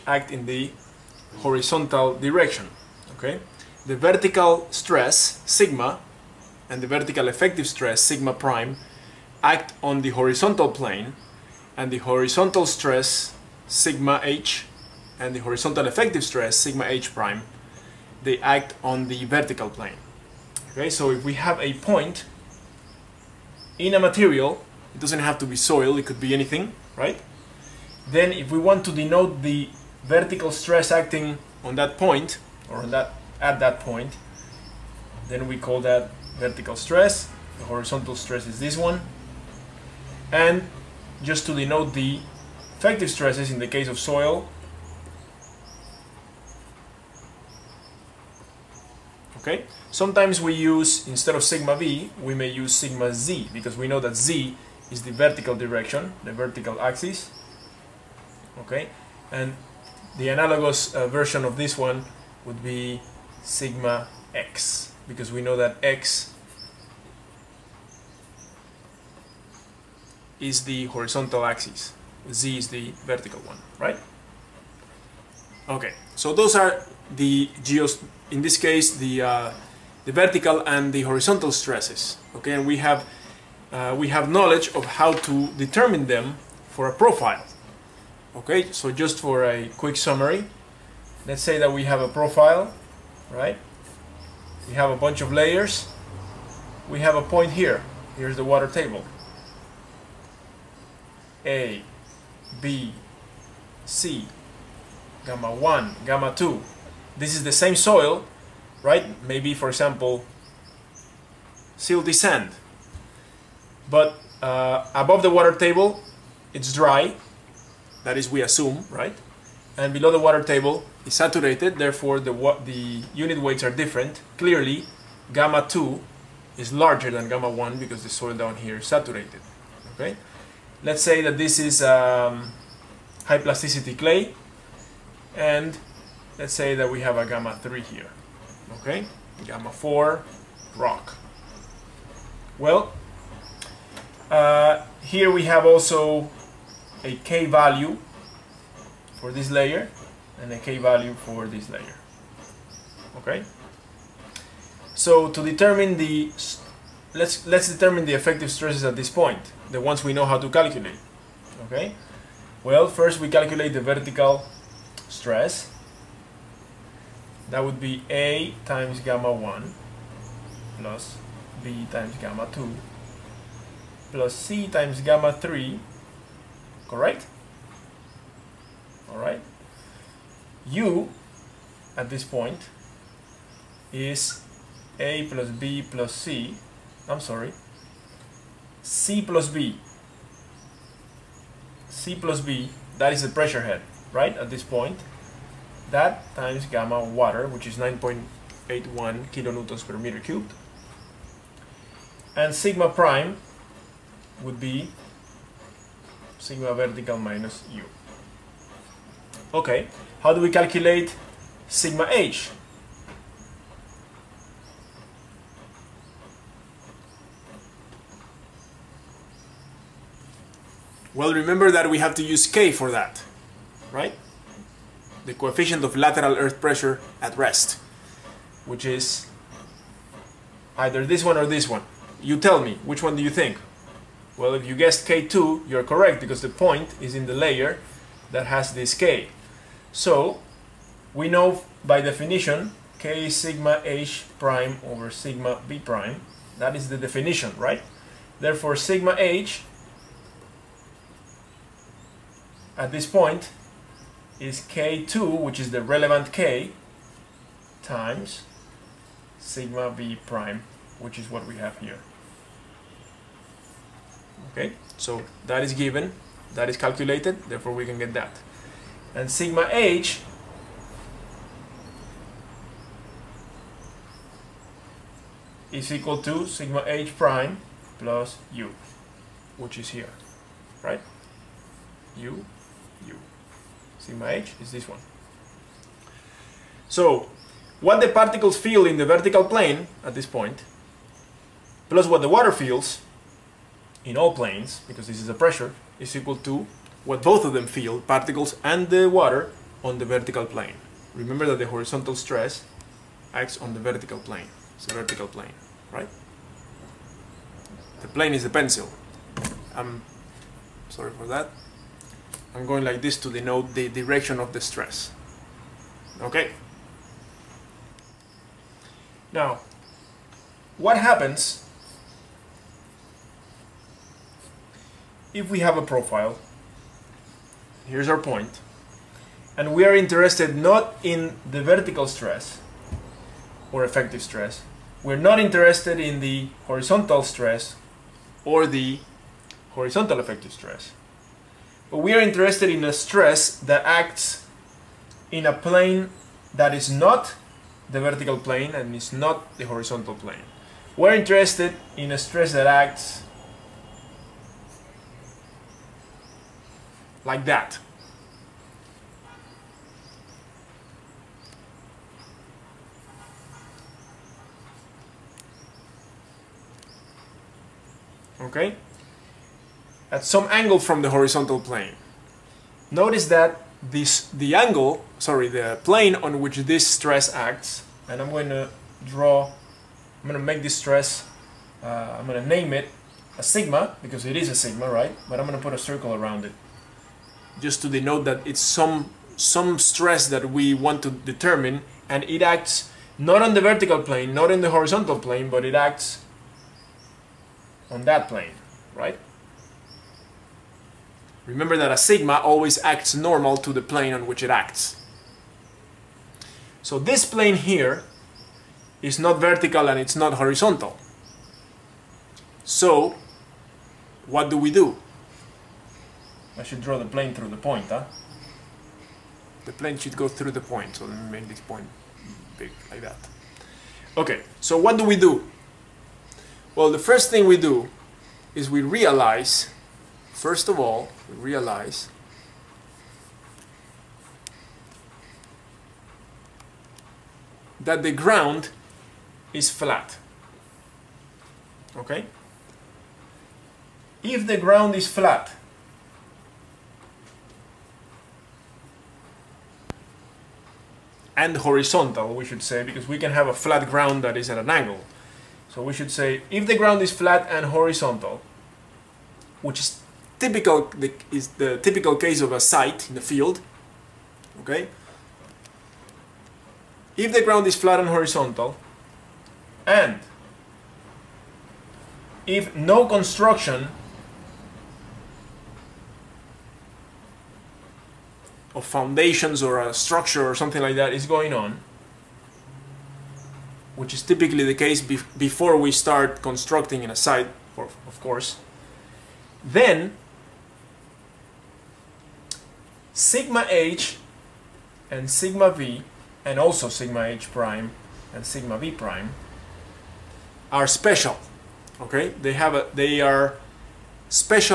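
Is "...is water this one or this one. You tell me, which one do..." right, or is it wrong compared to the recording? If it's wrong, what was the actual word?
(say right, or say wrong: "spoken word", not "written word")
wrong: "either", not "water".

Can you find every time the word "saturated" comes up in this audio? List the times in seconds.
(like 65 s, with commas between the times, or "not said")
121 s, 128 s.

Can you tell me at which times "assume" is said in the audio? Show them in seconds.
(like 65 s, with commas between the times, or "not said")
118 s.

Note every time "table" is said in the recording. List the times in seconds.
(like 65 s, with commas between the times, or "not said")
98 s, 115 s, 120 s.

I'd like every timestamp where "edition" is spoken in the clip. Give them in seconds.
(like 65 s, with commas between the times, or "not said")
not said.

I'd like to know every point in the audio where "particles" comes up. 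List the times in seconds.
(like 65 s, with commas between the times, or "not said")
288 s, 298 s.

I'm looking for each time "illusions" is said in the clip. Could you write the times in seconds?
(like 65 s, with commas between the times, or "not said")
not said.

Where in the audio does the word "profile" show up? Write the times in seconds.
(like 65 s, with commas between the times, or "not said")
86 s, 92 s, 325 s.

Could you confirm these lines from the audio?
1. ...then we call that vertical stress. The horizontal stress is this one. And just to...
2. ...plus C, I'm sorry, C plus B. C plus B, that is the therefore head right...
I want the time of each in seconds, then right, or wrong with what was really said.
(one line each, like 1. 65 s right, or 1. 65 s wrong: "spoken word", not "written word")
1. 35 s right
2. 185 s wrong: "pressure", not "therefore".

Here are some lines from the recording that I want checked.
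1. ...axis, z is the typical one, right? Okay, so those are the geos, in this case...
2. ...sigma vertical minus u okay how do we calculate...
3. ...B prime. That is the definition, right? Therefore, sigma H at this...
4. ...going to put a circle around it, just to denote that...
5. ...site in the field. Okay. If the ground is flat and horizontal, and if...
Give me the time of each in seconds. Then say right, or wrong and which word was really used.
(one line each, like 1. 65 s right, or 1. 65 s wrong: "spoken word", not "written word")
1. 71 s wrong: "vertical", not "typical"
2. 206 s right
3. 245 s right
4. 385 s right
5. 462 s right.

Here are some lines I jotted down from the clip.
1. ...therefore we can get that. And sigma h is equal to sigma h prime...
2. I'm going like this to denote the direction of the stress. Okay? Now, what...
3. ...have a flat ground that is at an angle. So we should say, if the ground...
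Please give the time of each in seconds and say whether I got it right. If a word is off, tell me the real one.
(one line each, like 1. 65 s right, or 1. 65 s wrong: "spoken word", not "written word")
1. 267 s right
2. 312 s right
3. 453 s right.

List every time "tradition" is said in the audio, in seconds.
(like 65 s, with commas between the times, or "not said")
not said.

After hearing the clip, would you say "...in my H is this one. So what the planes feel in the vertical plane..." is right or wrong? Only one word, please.
wrong.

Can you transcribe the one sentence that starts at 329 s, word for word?
And we are interested not in the vertical stress or effective stress.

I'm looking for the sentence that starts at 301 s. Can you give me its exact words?
Remember that the horizontal stress acts on the vertical plane.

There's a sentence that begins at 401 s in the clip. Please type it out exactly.
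Remember that a sigma always acts normal to the plane on which it acts.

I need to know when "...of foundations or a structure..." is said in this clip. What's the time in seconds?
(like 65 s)
478 s.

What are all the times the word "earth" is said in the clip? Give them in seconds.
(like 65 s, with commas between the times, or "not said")
226 s.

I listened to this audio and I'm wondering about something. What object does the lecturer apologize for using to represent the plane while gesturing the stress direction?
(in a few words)
the pencil.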